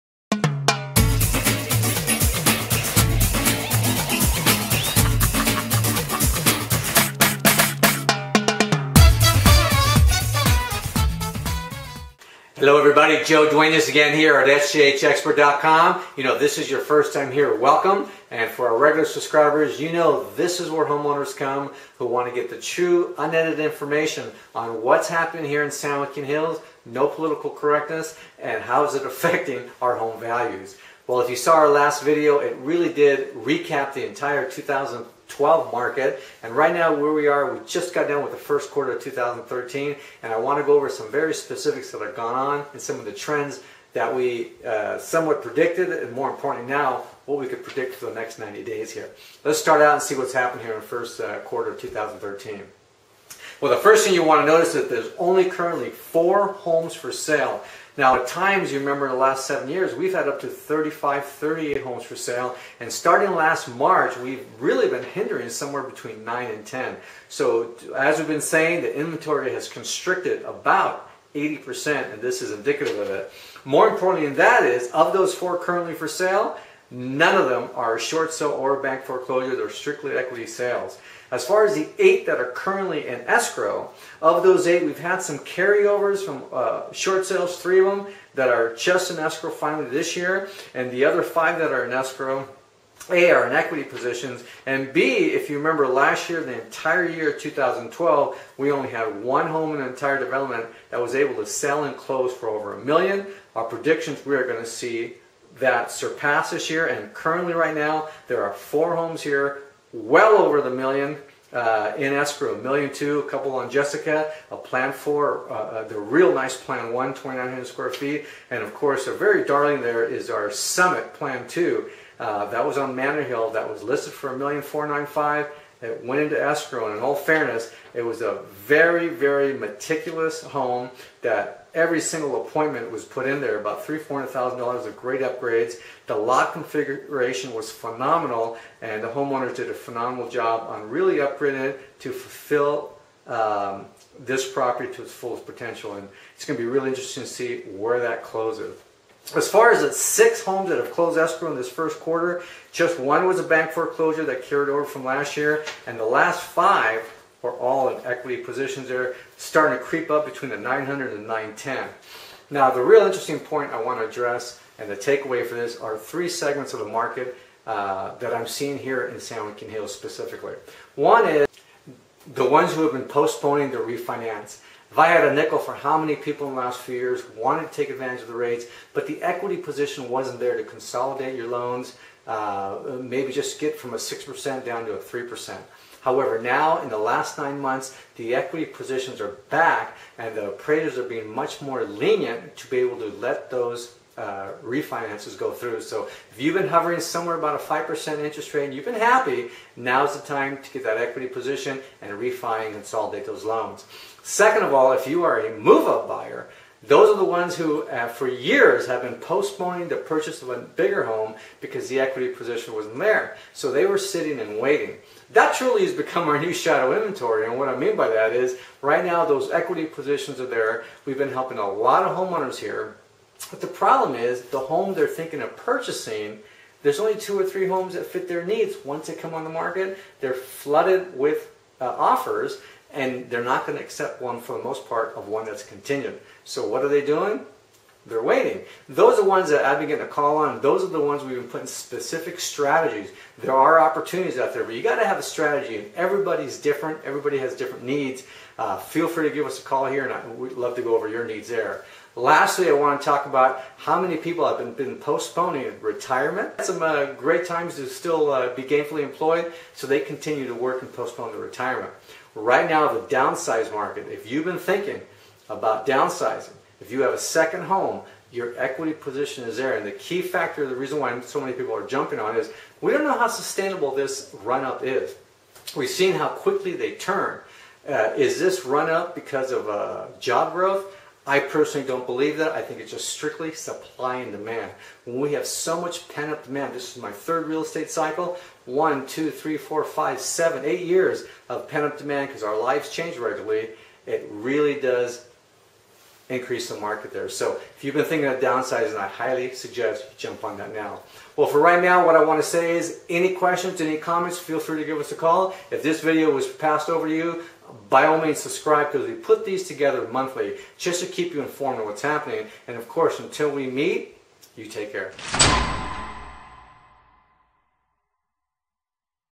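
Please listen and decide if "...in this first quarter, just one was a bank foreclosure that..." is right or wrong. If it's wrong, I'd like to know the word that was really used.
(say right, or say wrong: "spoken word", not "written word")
right.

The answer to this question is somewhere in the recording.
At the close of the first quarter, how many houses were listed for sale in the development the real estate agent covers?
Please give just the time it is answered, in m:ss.
0:55.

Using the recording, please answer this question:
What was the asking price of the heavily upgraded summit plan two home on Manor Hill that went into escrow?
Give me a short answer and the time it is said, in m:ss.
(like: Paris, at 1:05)
$1,495,000, at 2:04.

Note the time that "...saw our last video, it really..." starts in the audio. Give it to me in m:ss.
0:31.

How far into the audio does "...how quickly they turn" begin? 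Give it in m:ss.
4:36.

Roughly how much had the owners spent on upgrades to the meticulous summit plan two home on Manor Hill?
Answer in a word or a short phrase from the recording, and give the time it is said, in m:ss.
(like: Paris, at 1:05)
$300,000 to $400,000, at 2:13.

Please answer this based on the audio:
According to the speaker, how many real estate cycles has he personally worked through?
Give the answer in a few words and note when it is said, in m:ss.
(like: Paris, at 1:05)
3, at 4:47.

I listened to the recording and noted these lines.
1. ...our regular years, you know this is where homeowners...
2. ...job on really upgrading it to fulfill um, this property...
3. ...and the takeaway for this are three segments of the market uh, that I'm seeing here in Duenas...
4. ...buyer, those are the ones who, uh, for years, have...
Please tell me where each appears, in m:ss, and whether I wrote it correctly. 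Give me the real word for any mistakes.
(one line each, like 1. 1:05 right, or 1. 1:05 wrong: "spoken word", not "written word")
1. 0:18 wrong: "subscribers", not "years"
2. 2:20 right
3. 2:44 wrong: "San", not "Duenas"
4. 3:26 right.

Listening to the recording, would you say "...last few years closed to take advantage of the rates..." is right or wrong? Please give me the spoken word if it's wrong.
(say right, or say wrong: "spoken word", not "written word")
wrong: "wanted", not "closed".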